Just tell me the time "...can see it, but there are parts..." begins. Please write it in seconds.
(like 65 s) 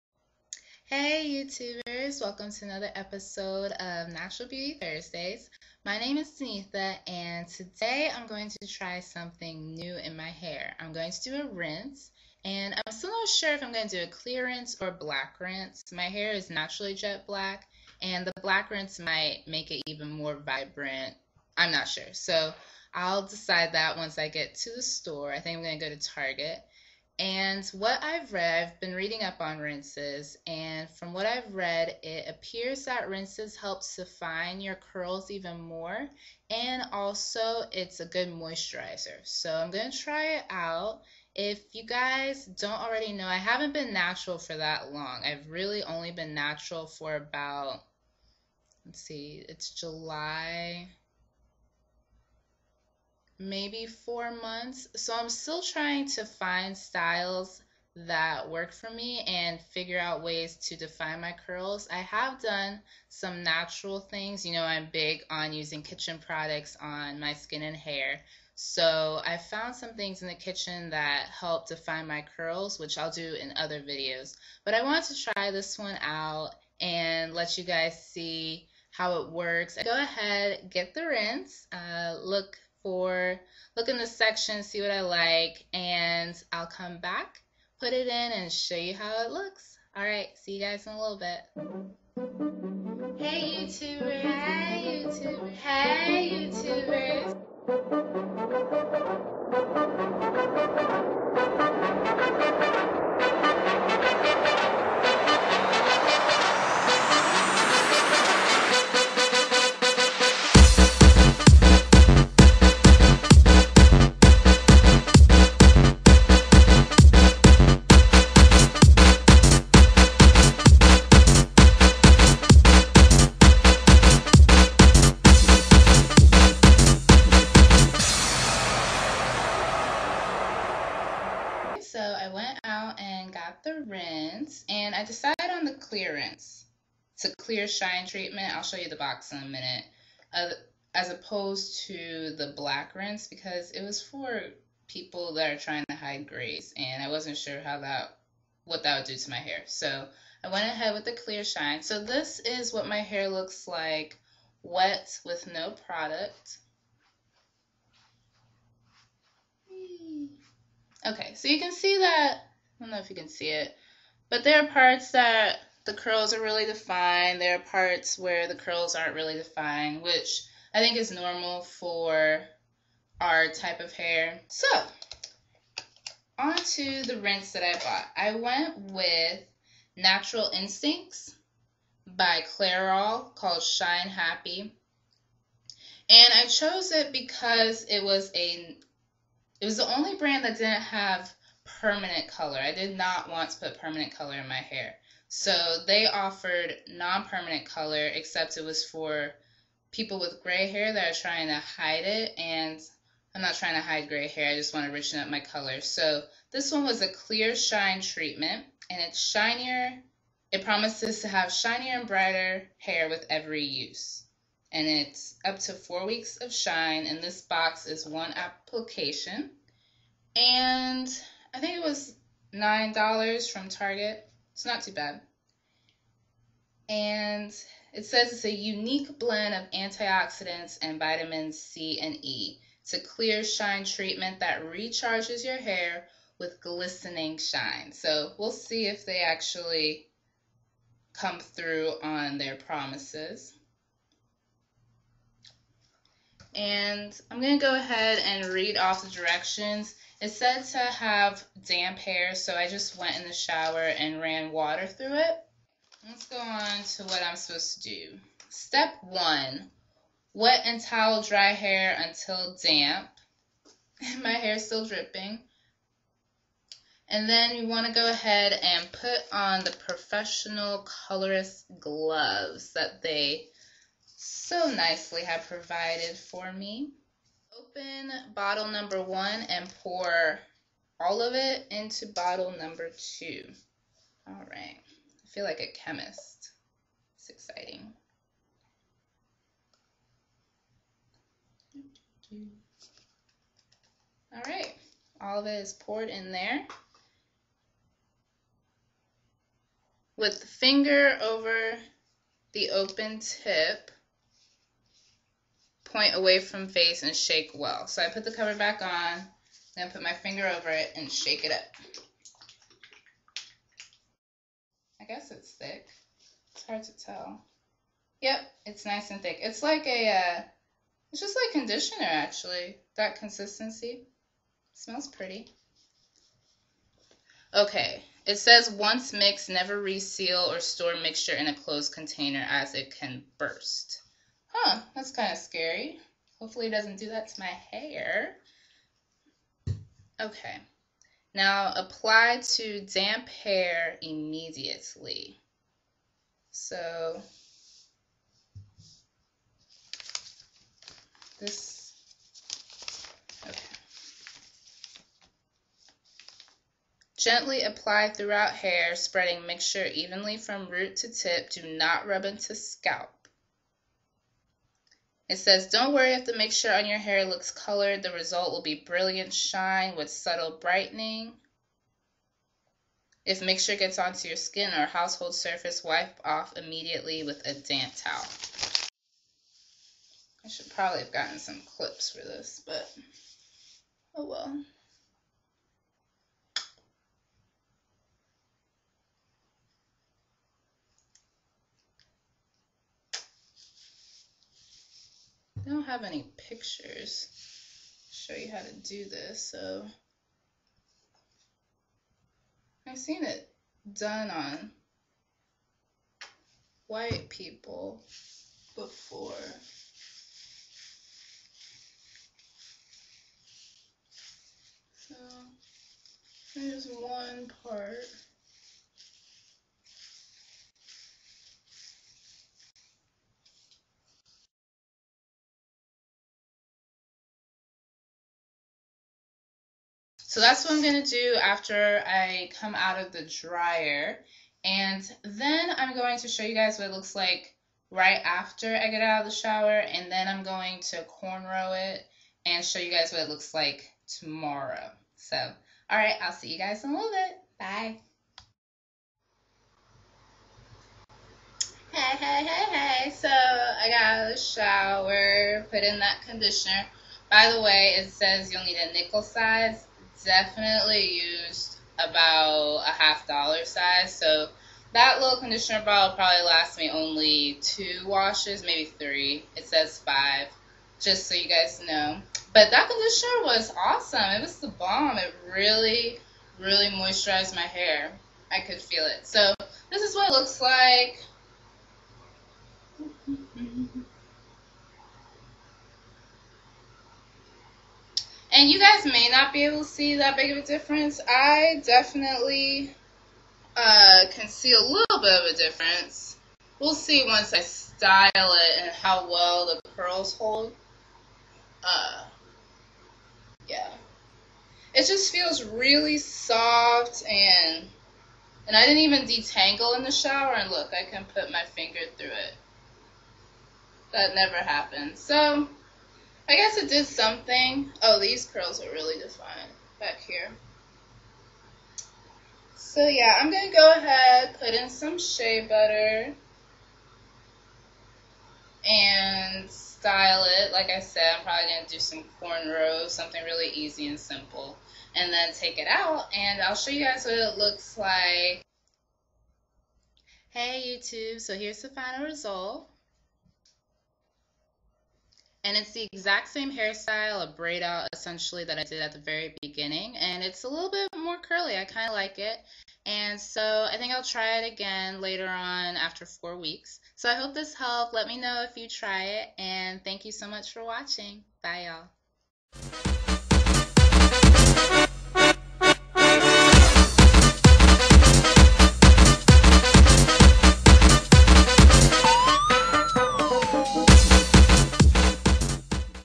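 163 s.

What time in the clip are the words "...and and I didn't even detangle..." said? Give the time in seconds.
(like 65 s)
507 s.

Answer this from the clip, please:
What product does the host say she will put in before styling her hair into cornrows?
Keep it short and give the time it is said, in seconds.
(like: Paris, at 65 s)
Shea butter, at 525 s.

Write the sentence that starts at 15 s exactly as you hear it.
My hair is naturally jet black and the black rinse might make it even more vibrant.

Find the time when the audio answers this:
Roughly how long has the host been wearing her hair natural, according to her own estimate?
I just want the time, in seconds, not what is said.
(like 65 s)
53 s.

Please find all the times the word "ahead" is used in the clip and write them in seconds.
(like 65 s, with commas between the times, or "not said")
80 s, 150 s, 247 s, 268 s, 523 s.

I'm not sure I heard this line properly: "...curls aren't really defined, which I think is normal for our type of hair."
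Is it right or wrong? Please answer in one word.
right.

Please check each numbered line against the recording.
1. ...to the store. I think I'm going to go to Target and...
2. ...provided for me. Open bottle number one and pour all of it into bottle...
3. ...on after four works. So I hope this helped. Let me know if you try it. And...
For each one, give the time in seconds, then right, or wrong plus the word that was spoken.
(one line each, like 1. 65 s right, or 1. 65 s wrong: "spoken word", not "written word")
1. 24 s right
2. 275 s right
3. 555 s wrong: "weeks", not "works".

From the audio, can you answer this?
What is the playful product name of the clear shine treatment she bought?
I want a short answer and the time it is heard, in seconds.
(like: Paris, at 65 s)
Shine Happy, at 183 s.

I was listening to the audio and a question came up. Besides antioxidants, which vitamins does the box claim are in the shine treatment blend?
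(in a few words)
C and E.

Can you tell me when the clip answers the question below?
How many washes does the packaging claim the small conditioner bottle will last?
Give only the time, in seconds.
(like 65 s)
469 s.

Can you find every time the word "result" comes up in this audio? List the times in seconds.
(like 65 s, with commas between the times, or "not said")
368 s, 542 s.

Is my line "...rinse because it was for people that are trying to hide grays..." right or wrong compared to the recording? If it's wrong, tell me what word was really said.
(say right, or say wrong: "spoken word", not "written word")
right.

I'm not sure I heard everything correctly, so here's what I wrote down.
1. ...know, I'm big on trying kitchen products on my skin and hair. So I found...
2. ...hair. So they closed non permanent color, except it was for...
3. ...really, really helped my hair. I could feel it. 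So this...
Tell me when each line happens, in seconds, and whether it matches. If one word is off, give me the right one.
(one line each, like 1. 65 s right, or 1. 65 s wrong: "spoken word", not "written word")
1. 64 s wrong: "using", not "trying"
2. 194 s wrong: "offered", not "closed"
3. 475 s wrong: "moisturized", not "helped".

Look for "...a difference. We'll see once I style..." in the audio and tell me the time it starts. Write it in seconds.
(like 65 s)
495 s.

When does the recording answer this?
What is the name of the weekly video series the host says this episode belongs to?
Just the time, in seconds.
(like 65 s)
4 s.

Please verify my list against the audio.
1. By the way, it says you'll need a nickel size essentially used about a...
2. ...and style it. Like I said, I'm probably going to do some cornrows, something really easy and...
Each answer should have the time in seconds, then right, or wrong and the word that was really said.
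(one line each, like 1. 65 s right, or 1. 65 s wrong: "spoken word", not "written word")
1. 457 s wrong: "definitely", not "essentially"
2. 528 s right.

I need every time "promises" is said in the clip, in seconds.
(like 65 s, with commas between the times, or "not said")
210 s, 242 s.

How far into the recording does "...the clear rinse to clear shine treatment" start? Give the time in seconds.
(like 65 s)
135 s.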